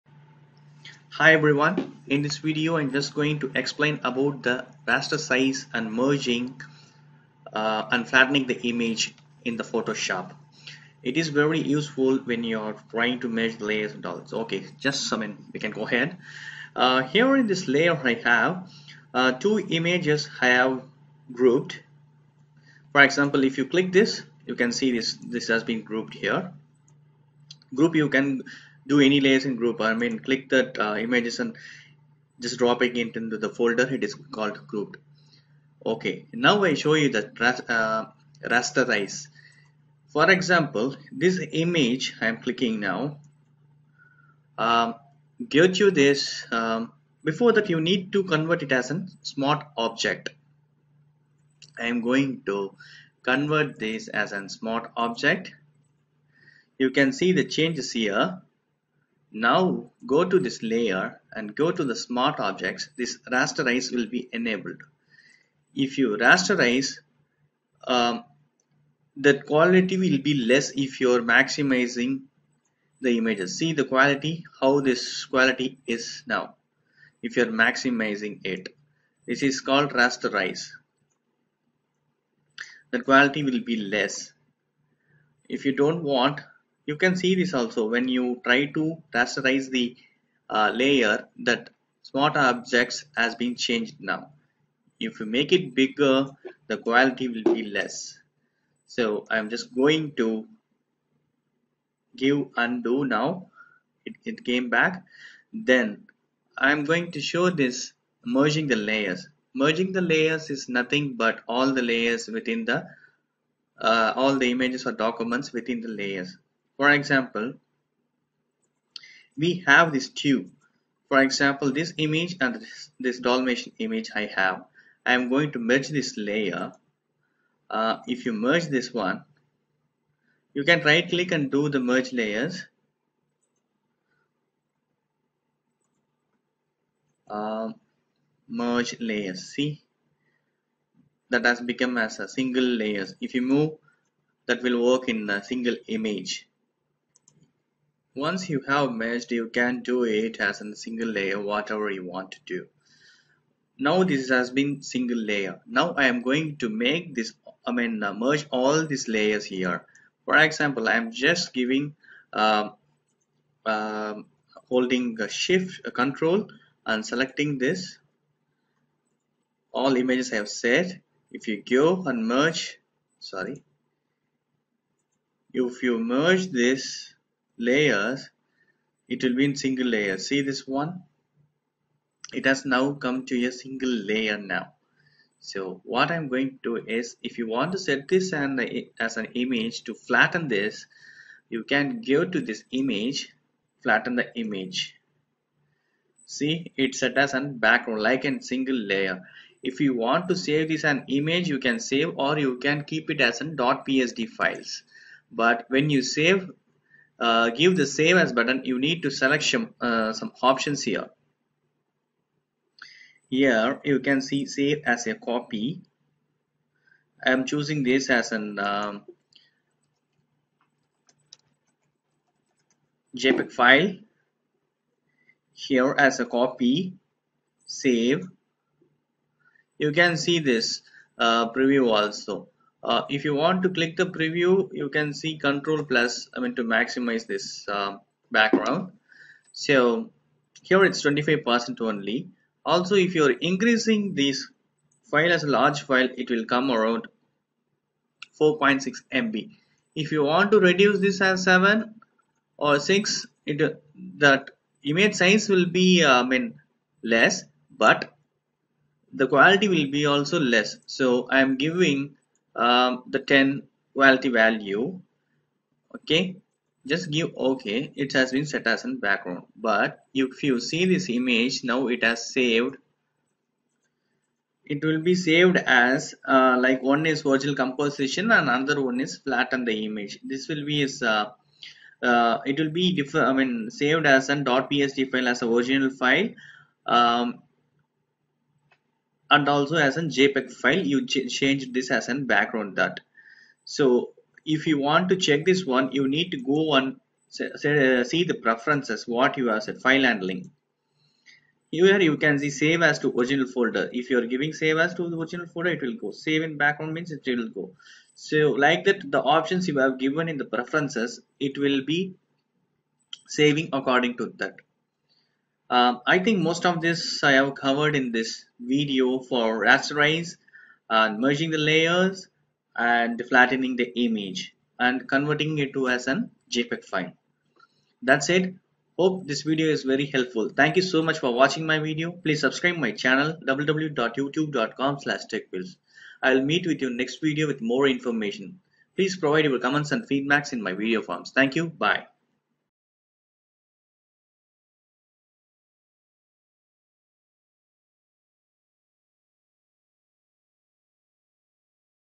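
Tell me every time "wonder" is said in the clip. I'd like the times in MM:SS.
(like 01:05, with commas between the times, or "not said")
not said.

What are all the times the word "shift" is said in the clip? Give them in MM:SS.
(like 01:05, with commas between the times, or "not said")
02:45.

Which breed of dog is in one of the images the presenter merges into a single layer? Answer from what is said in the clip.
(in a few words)
Dalmatian.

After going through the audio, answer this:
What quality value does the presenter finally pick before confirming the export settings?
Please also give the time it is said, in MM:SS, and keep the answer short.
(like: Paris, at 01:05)
10, at 04:23.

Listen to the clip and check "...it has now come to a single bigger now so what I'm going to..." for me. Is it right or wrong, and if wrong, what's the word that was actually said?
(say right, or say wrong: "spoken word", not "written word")
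wrong: "layer", not "bigger".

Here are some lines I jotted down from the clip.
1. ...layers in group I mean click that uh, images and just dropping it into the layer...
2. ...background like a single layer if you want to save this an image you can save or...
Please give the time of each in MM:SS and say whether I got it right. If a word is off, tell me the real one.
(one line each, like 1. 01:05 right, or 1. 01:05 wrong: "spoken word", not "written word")
1. 00:29 wrong: "folder", not "layer"
2. 03:17 right.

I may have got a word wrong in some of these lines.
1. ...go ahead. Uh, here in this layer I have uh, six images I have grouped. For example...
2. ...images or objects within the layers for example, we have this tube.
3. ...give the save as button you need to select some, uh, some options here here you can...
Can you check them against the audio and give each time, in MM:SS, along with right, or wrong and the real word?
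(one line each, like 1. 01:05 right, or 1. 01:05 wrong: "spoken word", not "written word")
1. 00:15 wrong: "two", not "six"
2. 01:54 wrong: "documents", not "objects"
3. 03:27 right.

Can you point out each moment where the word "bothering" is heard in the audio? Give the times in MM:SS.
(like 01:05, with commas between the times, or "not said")
not said.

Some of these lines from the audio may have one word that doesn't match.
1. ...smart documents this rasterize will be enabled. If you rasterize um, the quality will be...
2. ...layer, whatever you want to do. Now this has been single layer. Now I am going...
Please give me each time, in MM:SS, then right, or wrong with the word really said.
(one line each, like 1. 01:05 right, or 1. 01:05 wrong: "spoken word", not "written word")
1. 01:01 wrong: "objects", not "documents"
2. 02:31 right.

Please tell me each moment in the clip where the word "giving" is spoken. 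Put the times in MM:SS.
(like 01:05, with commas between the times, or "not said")
02:41, 04:21, 05:04.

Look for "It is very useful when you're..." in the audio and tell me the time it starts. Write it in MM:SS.
00:11.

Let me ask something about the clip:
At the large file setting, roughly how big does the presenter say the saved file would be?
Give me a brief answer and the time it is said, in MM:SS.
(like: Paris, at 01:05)
4.6 MB, at 04:08.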